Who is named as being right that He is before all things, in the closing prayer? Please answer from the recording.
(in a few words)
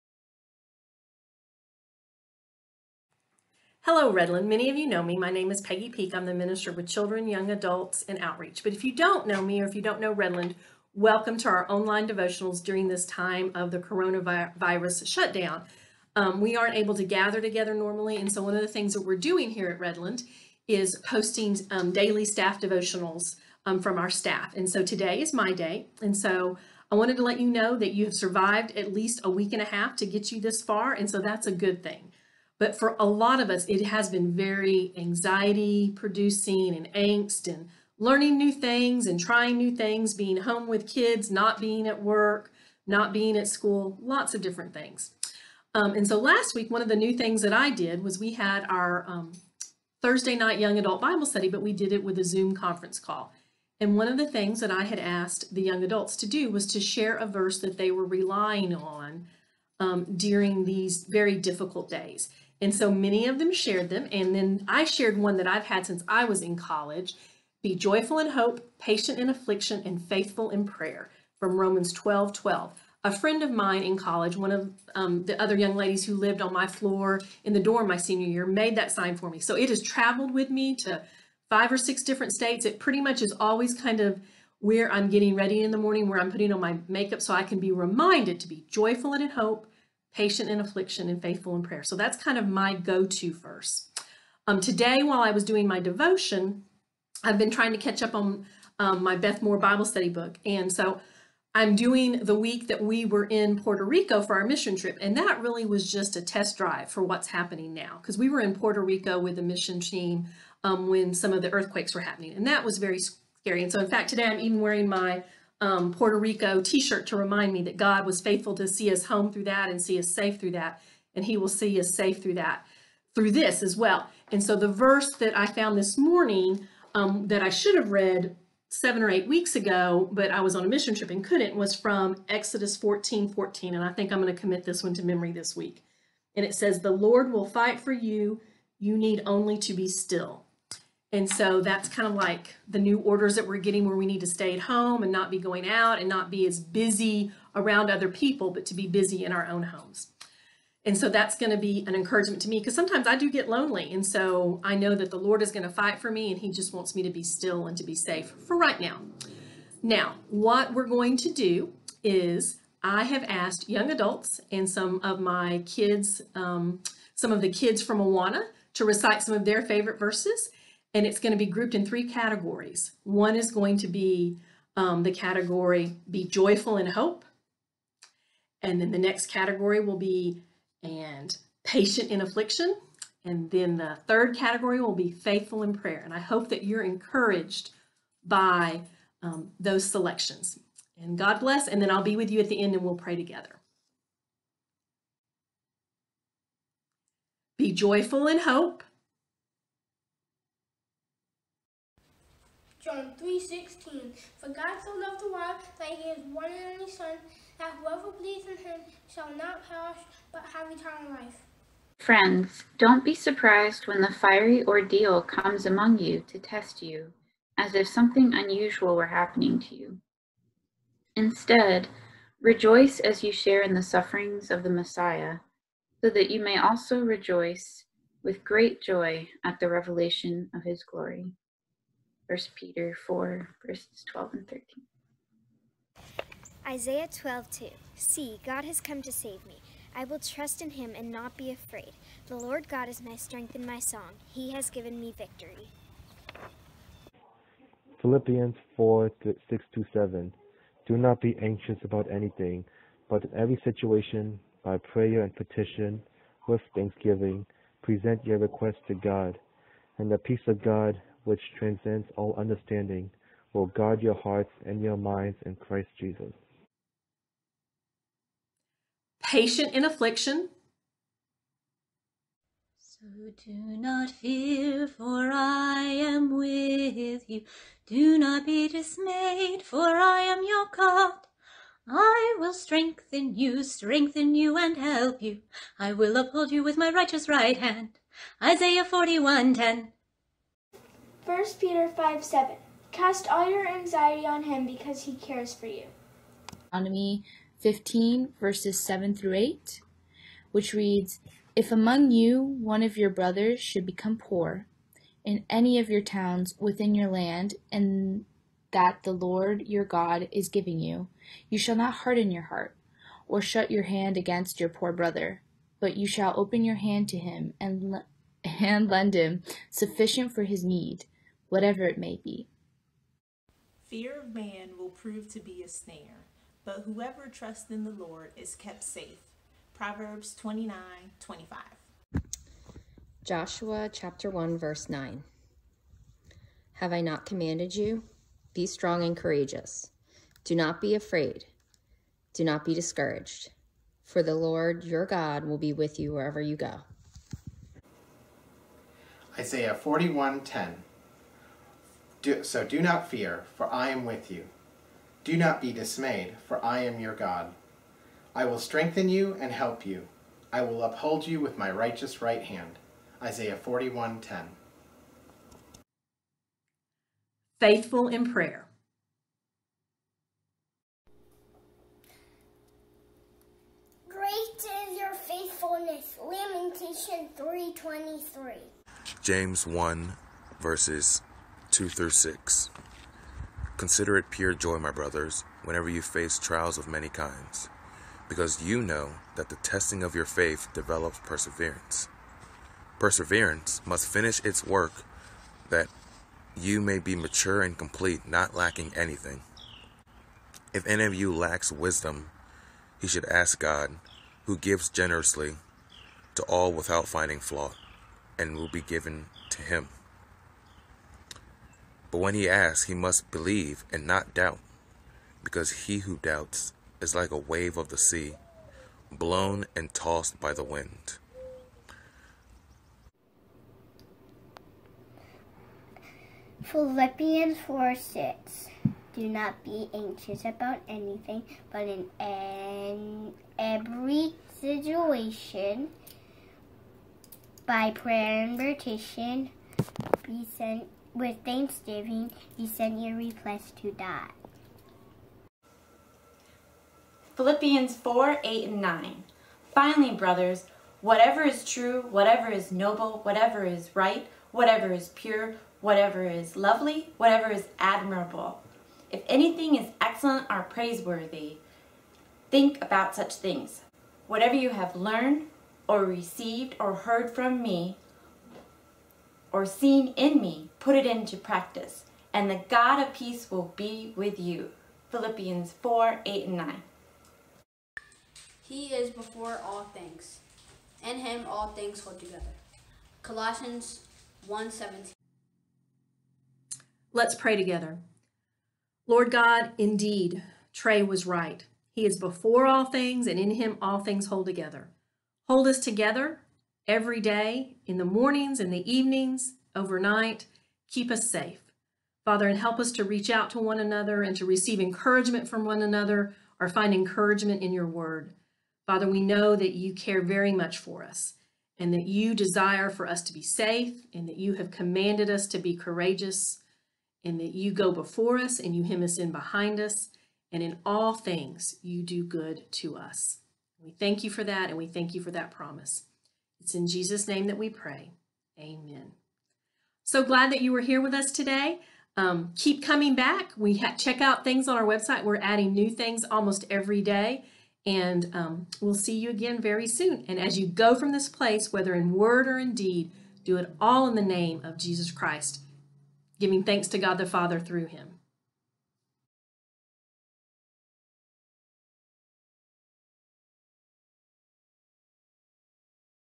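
Trey.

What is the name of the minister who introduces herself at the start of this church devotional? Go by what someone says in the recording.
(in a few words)
Peggy Peak.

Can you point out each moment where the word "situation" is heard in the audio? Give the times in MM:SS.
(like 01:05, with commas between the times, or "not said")
04:13, 07:14.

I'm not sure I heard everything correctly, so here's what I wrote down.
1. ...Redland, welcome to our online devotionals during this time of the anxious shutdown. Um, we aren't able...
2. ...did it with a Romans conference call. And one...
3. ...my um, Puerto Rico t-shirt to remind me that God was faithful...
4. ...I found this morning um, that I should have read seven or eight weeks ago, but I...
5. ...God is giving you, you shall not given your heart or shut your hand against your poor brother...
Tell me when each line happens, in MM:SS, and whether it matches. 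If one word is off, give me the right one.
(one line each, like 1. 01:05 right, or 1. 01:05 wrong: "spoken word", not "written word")
1. 00:10 wrong: "coronavirus", not "anxious"
2. 00:51 wrong: "Zoom", not "Romans"
3. 01:54 right
4. 02:05 right
5. 05:09 wrong: "harden", not "given".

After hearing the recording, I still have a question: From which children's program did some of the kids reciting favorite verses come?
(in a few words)
Awana.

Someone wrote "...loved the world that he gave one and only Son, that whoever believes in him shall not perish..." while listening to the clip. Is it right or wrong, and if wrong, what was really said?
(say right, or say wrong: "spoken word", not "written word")
right.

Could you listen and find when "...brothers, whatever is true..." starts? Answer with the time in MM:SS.
07:30.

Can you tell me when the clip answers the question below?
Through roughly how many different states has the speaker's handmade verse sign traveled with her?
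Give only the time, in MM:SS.
01:21.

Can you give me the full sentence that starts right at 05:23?
Fear of man will prove to be a snare, but whoever trusts in the Lord is kept safe.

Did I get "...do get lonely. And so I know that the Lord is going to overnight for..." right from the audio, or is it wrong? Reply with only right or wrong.
wrong.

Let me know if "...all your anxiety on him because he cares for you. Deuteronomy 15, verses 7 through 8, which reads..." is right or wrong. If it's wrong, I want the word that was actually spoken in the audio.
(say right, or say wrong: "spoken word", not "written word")
right.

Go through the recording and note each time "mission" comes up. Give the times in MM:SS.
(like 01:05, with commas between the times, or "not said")
01:44, 01:49, 02:10.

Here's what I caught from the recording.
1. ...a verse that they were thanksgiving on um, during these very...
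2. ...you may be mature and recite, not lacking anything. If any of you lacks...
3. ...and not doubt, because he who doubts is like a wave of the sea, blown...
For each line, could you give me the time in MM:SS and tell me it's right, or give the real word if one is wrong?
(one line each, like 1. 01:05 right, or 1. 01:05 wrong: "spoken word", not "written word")
1. 00:57 wrong: "relying", not "thanksgiving"
2. 06:36 wrong: "complete", not "recite"
3. 06:53 right.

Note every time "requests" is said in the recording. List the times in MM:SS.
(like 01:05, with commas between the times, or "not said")
04:18, 07:23.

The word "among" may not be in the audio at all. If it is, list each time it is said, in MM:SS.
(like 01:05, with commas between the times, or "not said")
03:35, 05:01.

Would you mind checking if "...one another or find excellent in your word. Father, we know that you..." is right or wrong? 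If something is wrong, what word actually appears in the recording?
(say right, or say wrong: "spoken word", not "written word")
wrong: "encouragement", not "excellent".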